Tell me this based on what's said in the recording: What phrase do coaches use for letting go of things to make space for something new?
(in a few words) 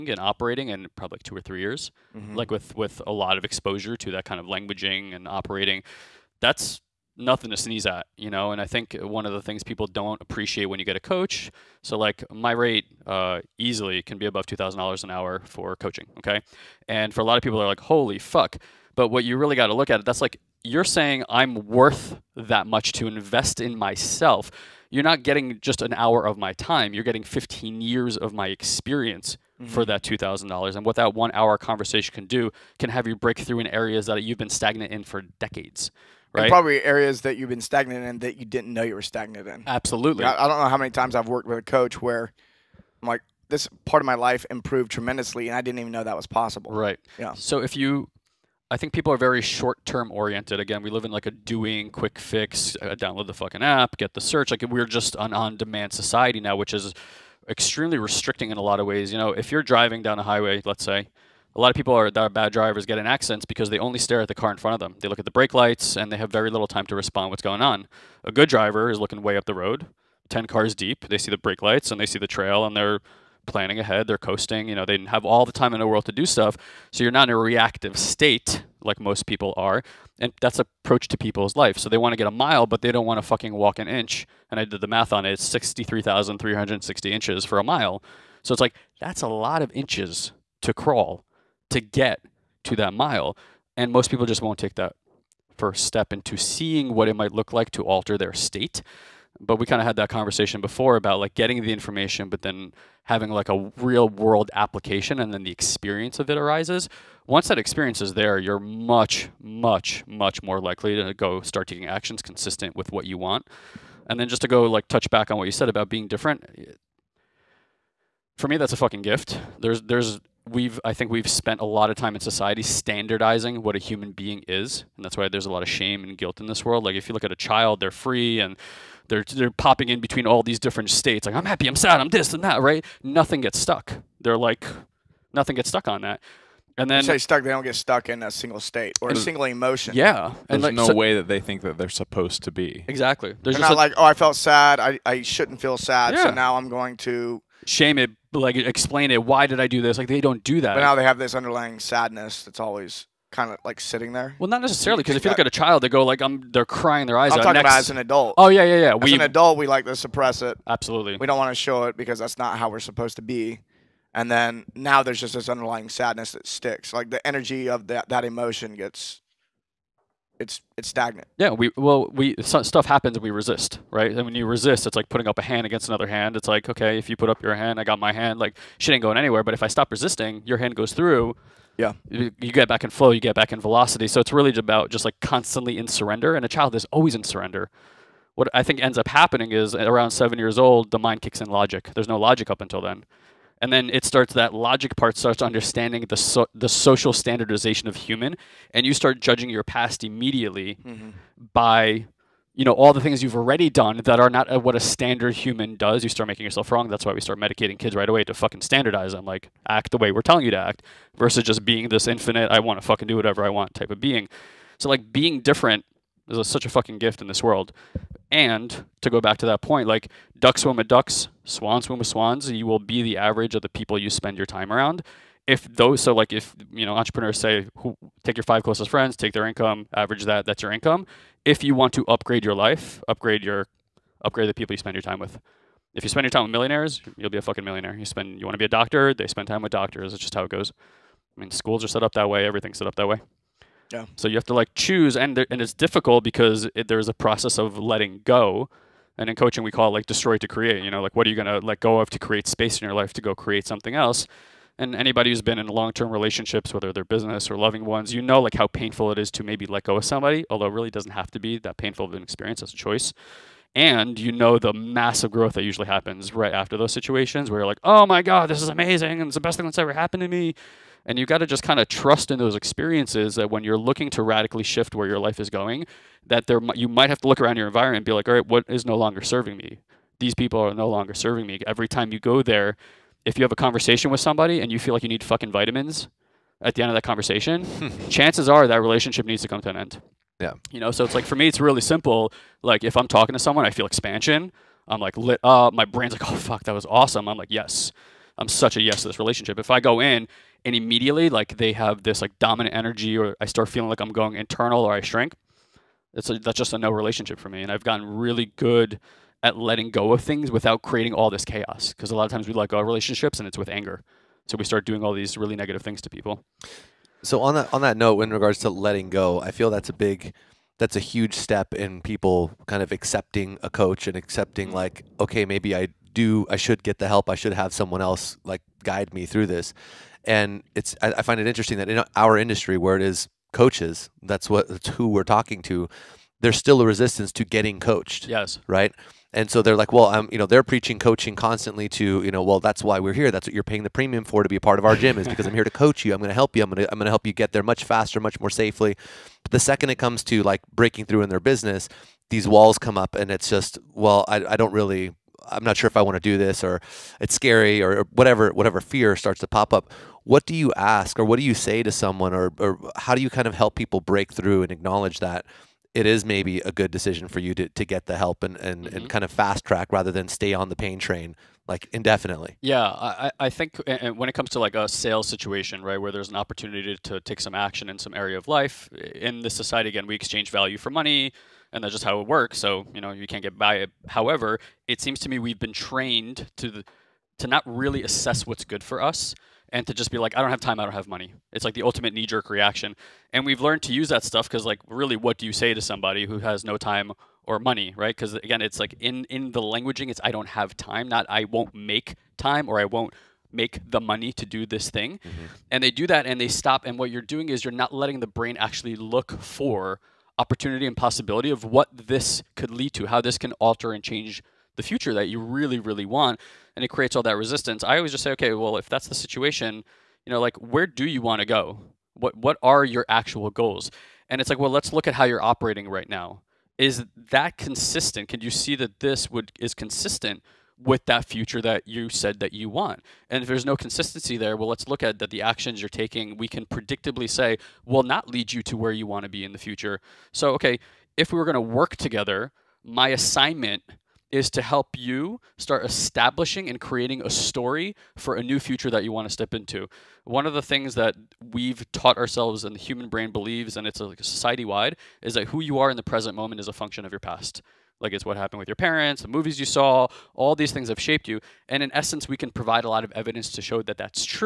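destroy to create.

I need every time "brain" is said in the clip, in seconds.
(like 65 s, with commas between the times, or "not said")
295 s, 408 s, 453 s.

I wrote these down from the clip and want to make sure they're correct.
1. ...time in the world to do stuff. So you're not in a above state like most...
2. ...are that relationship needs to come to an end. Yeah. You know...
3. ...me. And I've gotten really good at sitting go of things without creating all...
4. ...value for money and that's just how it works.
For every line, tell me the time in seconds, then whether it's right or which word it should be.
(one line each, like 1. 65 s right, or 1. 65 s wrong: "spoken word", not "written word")
1. 75 s wrong: "reactive", not "above"
2. 288 s right
3. 307 s wrong: "letting", not "sitting"
4. 380 s right.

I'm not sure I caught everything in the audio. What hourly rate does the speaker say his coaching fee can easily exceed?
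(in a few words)
$2,000.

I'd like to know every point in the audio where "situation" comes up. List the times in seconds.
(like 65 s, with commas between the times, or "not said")
266 s, 375 s, 419 s.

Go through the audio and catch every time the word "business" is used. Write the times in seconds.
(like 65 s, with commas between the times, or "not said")
257 s, 351 s.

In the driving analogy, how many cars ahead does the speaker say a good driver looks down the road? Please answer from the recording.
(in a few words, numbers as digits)
10 cars.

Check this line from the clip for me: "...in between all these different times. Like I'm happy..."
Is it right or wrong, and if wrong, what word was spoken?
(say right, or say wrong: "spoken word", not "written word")
wrong: "states", not "times".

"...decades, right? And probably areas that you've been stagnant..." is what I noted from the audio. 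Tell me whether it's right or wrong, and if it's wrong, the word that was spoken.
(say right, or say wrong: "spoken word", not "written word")
right.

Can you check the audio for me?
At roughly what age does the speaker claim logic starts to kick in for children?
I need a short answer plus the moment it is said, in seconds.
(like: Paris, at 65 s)
7, at 190 s.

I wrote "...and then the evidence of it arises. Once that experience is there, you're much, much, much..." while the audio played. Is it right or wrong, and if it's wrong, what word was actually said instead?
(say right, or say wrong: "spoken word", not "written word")
wrong: "experience", not "evidence".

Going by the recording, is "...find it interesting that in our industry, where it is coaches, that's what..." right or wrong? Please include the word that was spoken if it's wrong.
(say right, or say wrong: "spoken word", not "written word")
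right.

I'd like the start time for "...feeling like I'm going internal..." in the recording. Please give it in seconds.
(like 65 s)
303 s.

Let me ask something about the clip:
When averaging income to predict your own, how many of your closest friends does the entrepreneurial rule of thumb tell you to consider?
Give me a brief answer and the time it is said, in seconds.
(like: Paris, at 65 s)
5, at 228 s.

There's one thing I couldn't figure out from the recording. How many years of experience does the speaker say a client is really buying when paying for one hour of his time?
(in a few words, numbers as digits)
15.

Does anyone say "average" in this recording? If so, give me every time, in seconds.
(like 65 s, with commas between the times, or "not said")
223 s, 229 s.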